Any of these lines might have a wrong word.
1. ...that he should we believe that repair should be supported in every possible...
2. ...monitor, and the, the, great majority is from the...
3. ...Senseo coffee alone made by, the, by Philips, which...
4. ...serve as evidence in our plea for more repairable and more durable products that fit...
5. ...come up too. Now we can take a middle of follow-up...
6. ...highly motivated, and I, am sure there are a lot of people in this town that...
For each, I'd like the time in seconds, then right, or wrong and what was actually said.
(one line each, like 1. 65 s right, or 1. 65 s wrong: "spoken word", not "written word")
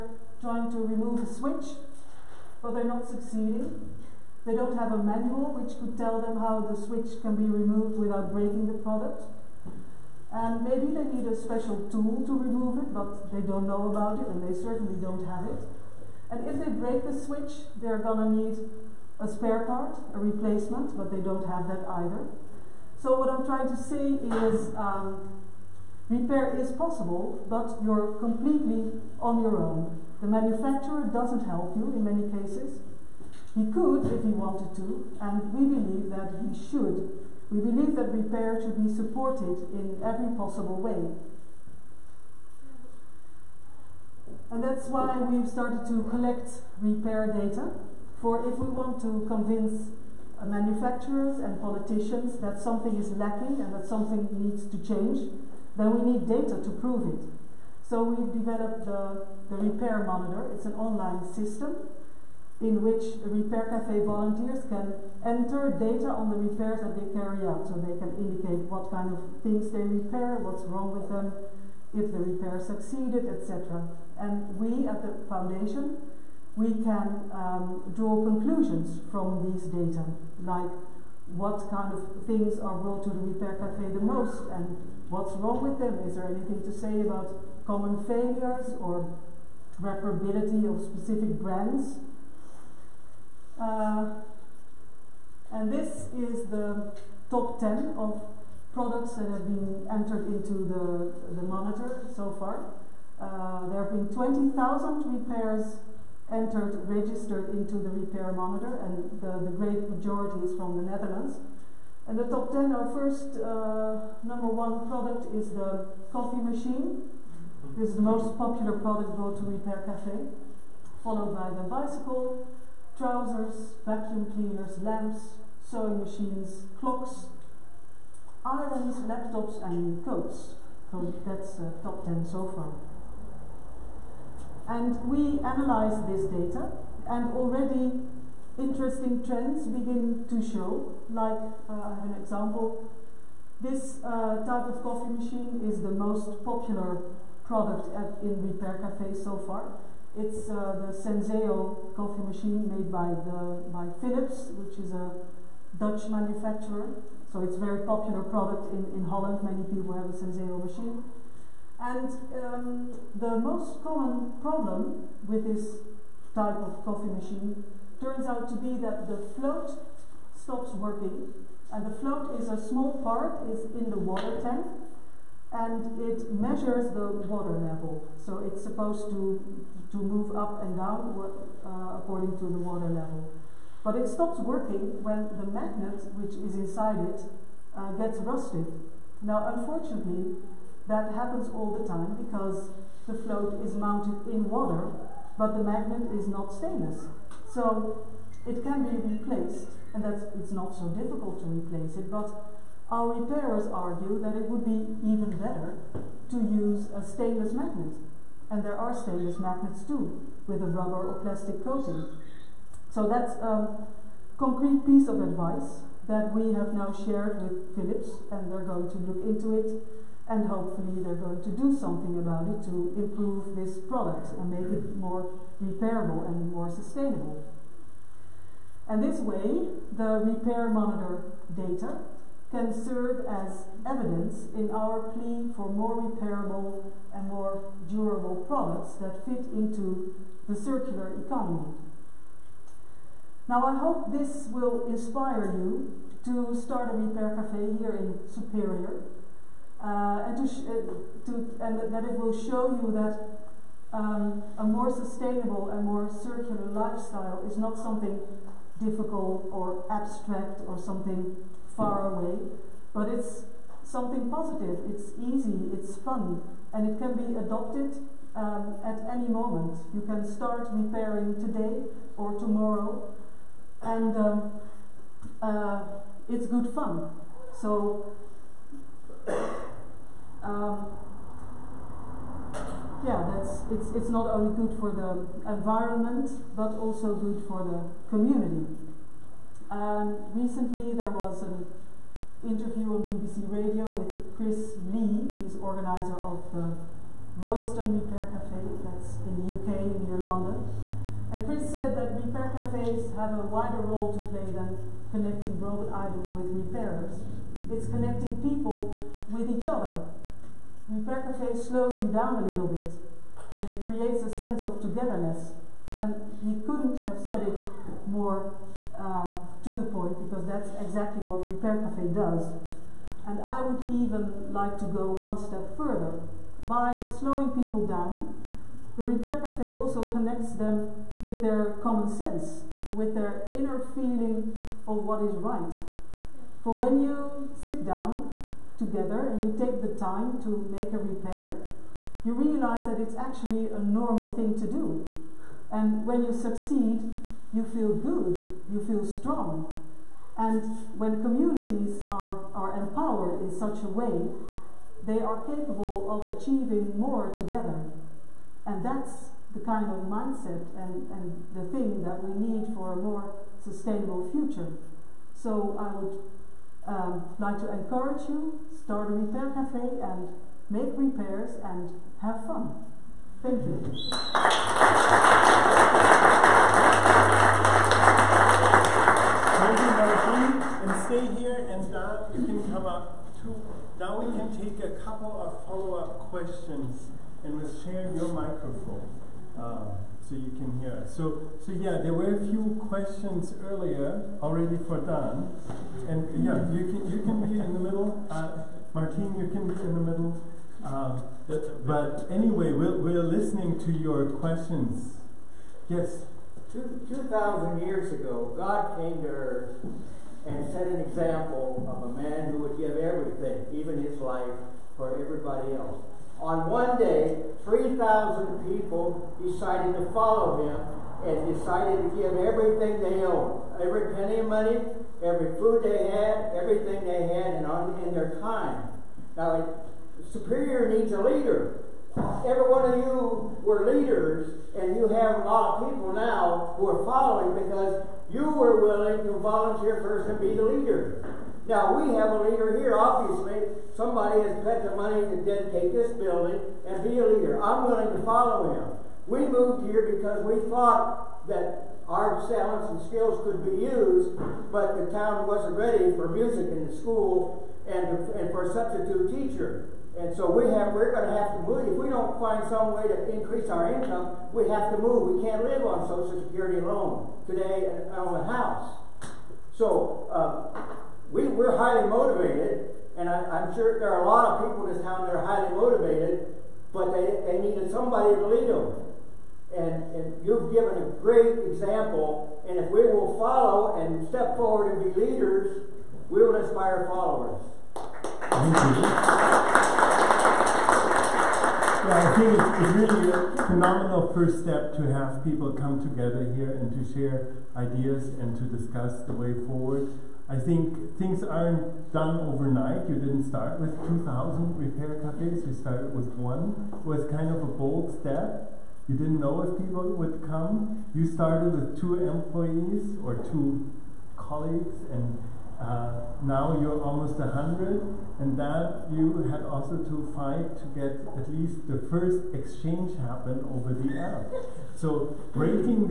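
1. 36 s right
2. 108 s right
3. 150 s wrong: "machine", not "alone"
4. 232 s right
5. 382 s wrong: "couple", not "middle"
6. 471 s right.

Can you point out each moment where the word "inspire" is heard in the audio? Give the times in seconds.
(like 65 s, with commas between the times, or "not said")
244 s, 486 s.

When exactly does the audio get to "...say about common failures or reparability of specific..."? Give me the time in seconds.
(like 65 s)
86 s.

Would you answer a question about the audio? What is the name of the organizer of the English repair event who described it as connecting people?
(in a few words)
Chris Lee.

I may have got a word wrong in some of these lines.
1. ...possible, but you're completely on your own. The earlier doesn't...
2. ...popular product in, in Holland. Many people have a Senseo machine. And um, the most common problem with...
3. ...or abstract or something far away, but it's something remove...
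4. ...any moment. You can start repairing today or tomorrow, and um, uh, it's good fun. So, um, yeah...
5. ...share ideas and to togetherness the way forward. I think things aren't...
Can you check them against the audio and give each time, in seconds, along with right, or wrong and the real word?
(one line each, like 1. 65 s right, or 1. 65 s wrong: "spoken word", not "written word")
1. 26 s wrong: "manufacturer", not "earlier"
2. 157 s right
3. 259 s wrong: "positive", not "remove"
4. 269 s right
5. 497 s wrong: "discuss", not "togetherness".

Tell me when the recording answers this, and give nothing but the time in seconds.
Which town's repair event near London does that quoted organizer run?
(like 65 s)
297 s.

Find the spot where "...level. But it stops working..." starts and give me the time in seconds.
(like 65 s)
182 s.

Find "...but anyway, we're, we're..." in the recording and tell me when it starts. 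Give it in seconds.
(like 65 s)
401 s.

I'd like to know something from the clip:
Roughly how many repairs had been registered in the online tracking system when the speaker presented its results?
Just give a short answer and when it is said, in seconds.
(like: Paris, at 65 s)
20,000, at 104 s.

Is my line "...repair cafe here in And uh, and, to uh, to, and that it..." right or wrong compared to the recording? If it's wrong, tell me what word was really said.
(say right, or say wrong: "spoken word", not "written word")
wrong: "Superior", not "And".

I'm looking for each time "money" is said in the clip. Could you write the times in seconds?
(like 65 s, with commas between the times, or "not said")
424 s, 444 s.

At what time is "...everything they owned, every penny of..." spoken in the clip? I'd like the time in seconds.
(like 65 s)
422 s.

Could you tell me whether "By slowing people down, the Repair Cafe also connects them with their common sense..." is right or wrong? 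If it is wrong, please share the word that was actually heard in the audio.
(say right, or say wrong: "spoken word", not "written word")
right.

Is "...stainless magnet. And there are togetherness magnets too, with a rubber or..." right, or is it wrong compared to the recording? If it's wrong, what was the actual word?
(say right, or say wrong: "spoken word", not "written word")
wrong: "stainless", not "togetherness".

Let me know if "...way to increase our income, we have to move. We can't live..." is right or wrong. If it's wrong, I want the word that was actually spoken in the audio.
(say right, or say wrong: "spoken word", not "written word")
right.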